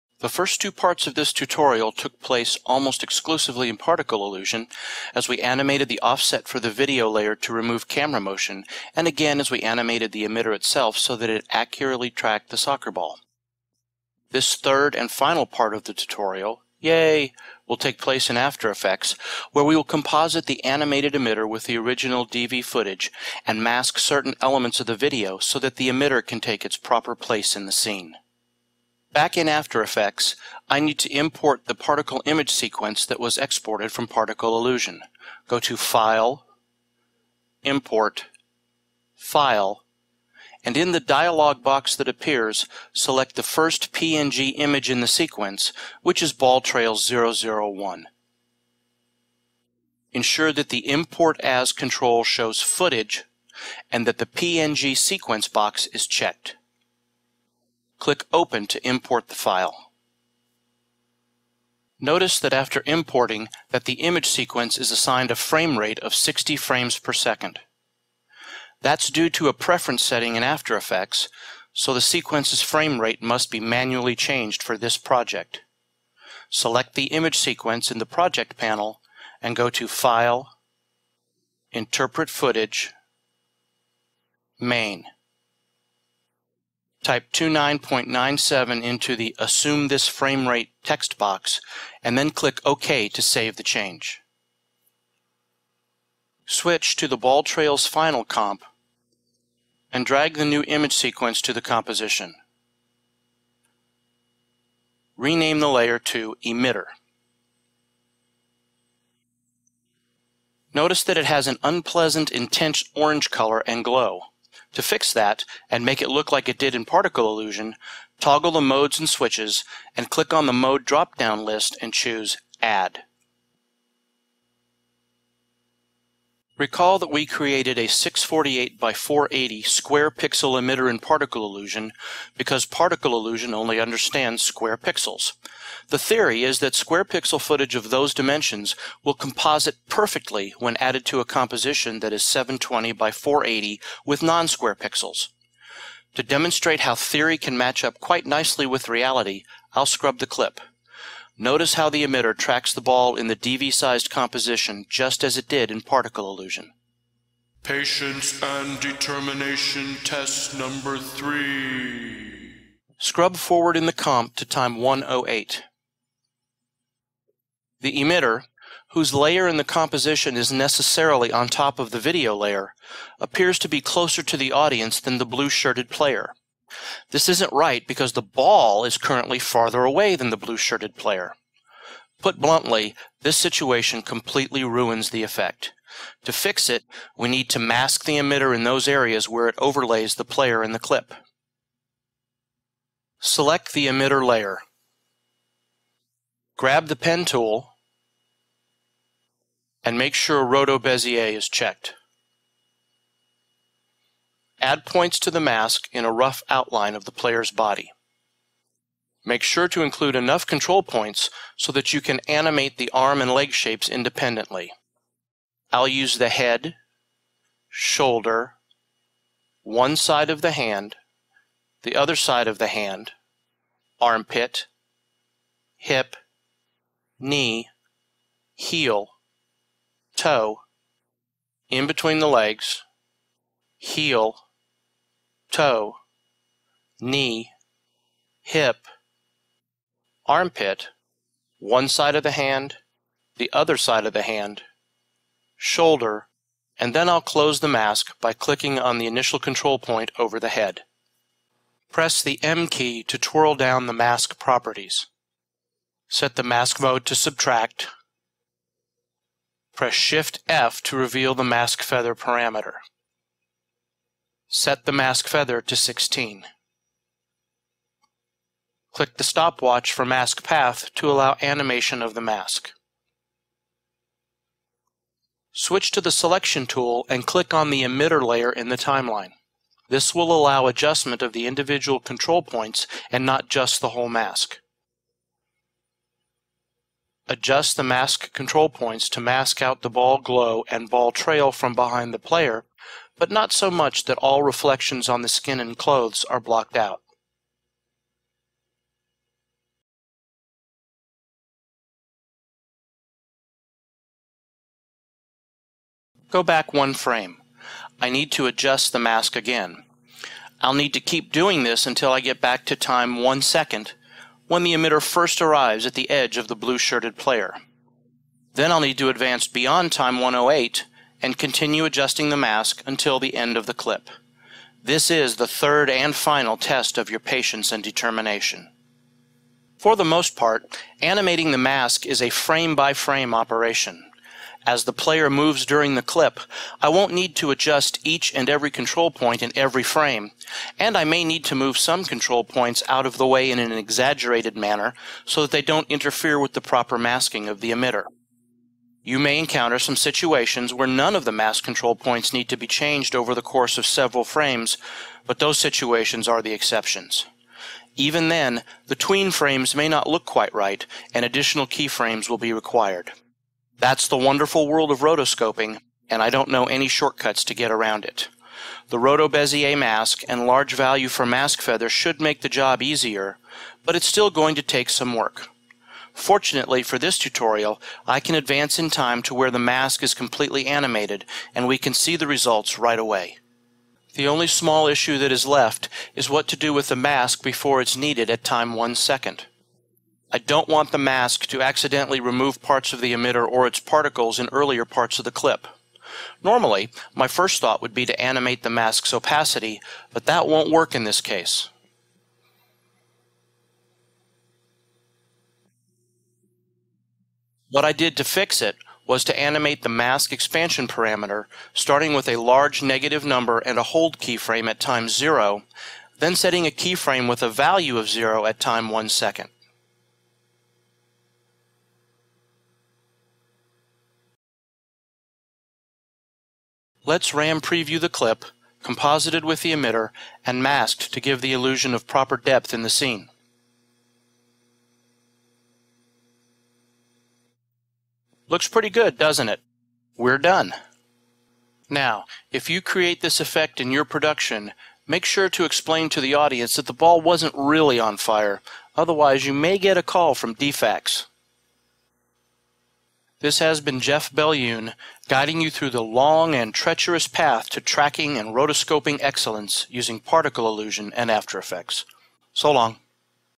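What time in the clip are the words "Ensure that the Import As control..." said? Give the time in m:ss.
0:50.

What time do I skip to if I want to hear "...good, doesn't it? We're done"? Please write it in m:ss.
7:18.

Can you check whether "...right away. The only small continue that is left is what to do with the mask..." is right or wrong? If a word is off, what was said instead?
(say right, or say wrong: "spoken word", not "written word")
wrong: "issue", not "continue".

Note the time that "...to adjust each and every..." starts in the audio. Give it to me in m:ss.
5:37.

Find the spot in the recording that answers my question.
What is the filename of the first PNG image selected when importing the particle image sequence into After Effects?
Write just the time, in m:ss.
0:46.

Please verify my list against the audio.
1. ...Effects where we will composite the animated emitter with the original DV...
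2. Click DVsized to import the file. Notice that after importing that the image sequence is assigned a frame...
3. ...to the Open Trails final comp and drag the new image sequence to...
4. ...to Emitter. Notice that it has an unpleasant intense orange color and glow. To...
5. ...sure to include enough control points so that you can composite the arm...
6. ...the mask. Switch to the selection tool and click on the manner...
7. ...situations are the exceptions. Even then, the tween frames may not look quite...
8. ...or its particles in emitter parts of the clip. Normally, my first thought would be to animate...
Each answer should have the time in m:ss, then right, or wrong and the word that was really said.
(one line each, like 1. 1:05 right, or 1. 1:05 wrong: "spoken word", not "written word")
1. 0:18 right
2. 0:58 wrong: "Open", not "DVsized"
3. 1:36 wrong: "Ball", not "Open"
4. 1:45 right
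5. 3:29 wrong: "animate", not "composite"
6. 4:32 wrong: "emitter", not "manner"
7. 5:55 right
8. 6:33 wrong: "earlier", not "emitter".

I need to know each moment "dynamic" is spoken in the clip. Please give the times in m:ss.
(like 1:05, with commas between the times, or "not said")
not said.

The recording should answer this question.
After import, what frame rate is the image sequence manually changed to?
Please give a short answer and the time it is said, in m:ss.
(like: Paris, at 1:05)
29.97, at 1:27.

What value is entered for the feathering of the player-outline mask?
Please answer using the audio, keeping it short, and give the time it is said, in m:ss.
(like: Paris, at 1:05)
16, at 4:25.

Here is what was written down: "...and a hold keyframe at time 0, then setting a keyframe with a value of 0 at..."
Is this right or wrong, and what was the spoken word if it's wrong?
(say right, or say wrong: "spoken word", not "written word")
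right.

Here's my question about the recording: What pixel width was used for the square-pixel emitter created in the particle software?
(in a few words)
648.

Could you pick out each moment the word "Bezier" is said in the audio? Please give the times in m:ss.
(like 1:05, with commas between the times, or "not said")
3:20, 6:09.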